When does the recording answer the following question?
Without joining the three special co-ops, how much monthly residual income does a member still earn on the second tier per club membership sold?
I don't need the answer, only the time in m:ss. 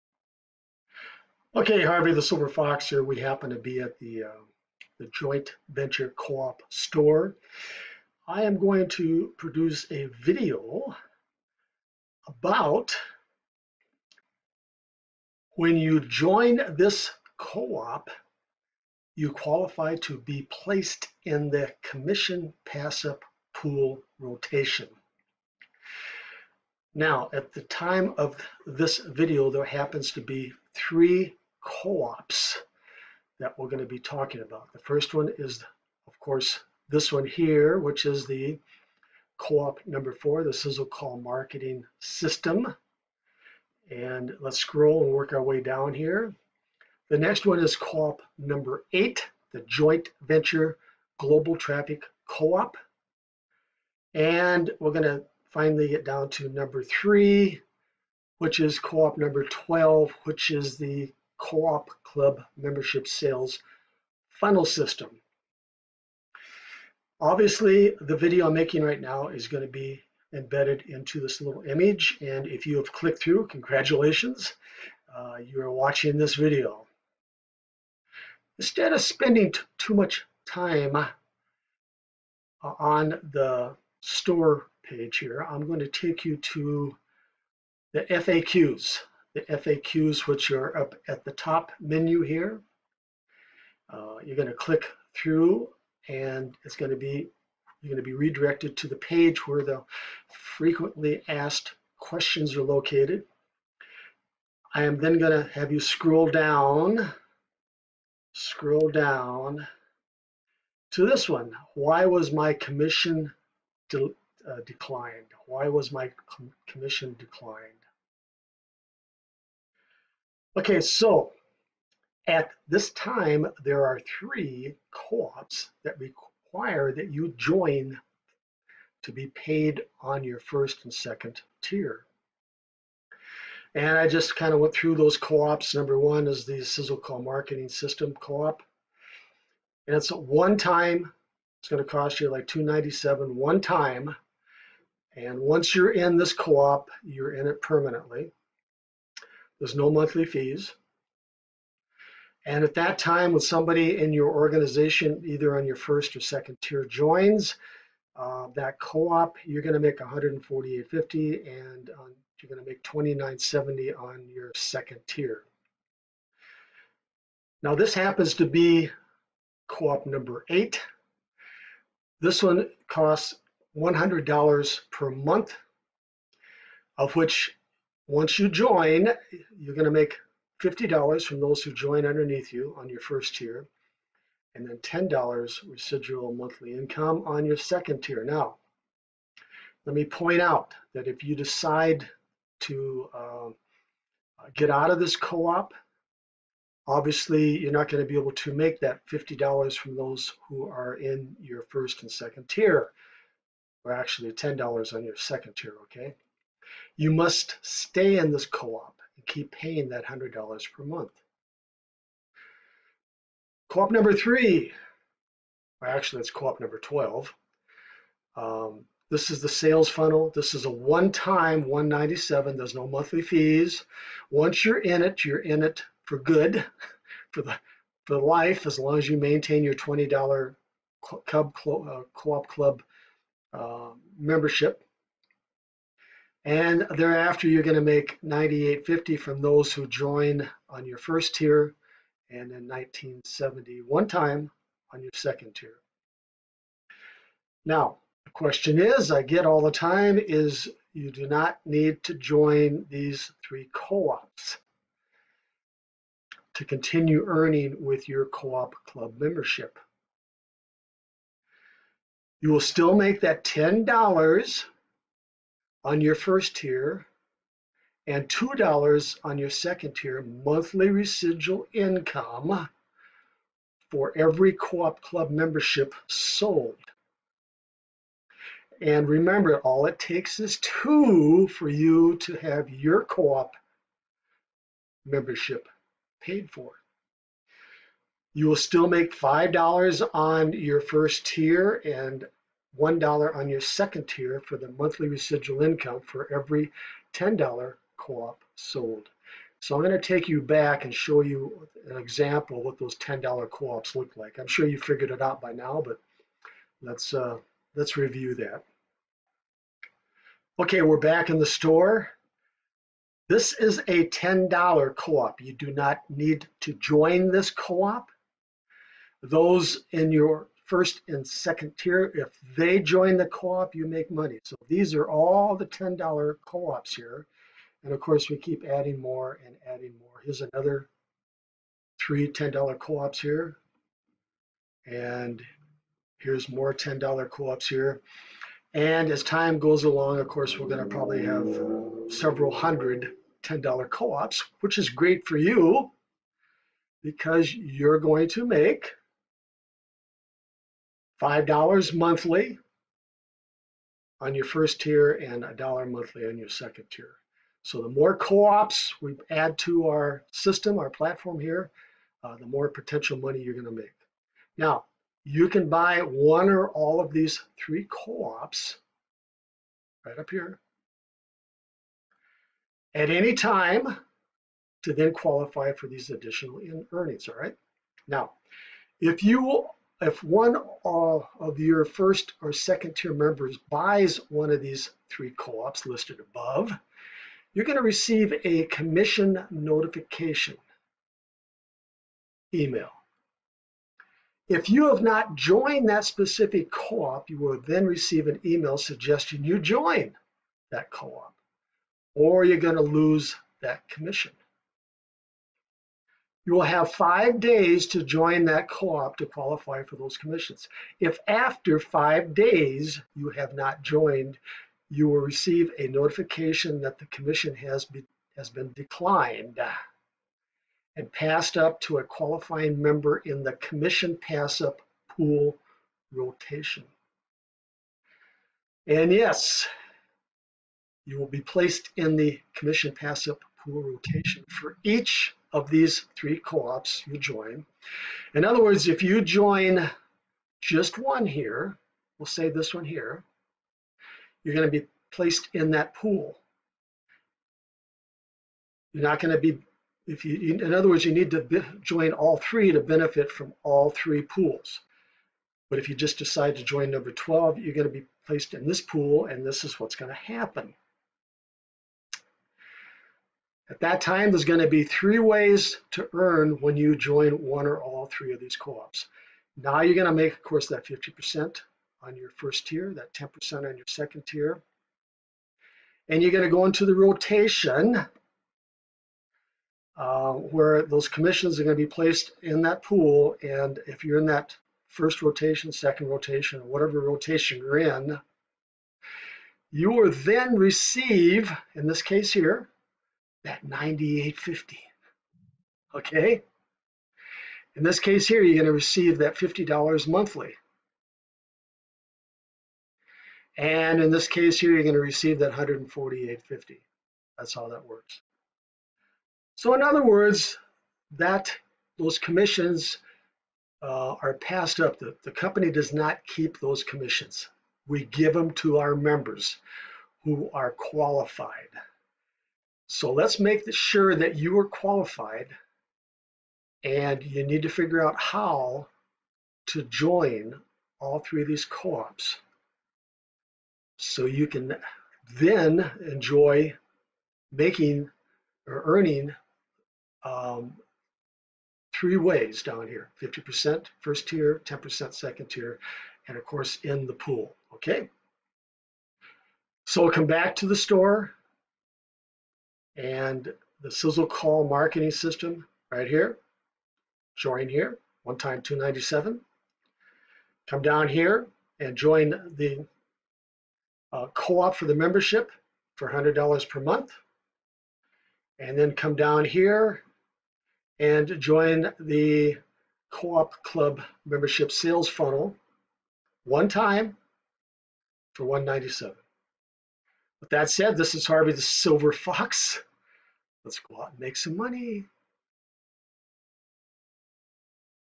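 4:28.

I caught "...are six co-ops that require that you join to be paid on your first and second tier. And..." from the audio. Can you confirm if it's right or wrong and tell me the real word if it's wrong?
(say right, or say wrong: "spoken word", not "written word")
wrong: "three", not "six".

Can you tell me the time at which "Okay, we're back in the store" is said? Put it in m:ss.
5:10.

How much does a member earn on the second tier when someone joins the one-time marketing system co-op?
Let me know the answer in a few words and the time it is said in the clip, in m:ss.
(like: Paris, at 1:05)
$29.70, at 2:42.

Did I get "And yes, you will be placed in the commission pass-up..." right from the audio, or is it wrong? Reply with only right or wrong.
right.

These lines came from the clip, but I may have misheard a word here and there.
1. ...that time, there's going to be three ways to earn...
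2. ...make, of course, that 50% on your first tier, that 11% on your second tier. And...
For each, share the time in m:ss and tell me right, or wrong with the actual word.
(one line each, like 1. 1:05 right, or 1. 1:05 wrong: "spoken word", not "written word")
1. 7:43 right
2. 7:50 wrong: "10", not "11".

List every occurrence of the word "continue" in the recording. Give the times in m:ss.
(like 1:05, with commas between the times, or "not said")
4:16.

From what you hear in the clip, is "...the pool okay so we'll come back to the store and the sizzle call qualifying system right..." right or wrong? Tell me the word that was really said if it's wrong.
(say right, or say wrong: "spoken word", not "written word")
wrong: "marketing", not "qualifying".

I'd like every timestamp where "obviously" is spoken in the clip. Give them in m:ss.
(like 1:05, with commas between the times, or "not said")
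1:07, 3:16.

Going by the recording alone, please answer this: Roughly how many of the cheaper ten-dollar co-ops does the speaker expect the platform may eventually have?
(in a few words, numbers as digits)
several hundred.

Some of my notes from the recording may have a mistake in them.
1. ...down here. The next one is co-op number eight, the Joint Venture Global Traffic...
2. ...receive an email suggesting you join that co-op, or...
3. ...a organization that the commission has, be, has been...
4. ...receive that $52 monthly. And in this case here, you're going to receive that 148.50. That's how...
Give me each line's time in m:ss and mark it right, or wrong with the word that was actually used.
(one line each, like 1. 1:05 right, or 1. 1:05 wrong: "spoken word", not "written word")
1. 0:45 right
2. 6:37 right
3. 6:55 wrong: "notification", not "organization"
4. 8:18 wrong: "50", not "52".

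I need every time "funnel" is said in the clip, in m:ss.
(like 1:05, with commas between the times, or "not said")
1:04, 3:39, 9:35.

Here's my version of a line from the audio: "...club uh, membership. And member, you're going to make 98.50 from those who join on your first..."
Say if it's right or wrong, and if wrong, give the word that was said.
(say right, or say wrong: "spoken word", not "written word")
wrong: "thereafter", not "member".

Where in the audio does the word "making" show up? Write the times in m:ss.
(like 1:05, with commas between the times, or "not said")
1:08, 8:57.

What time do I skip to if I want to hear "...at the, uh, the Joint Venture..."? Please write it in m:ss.
0:03.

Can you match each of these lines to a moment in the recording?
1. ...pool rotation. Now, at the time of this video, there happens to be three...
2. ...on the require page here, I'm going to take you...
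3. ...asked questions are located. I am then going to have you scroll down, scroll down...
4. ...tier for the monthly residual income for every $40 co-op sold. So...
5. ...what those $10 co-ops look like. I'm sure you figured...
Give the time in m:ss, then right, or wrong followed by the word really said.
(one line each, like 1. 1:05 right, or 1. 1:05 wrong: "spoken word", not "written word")
1. 0:23 right
2. 1:22 wrong: "store", not "require"
3. 1:41 right
4. 4:54 wrong: "10", not "40"
5. 5:02 right.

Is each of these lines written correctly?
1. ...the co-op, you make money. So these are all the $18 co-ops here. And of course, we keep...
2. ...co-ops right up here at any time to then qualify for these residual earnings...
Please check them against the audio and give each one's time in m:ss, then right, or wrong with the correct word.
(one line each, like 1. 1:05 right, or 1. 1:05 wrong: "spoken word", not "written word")
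1. 5:23 wrong: "10", not "18"
2. 6:07 wrong: "additional", not "residual".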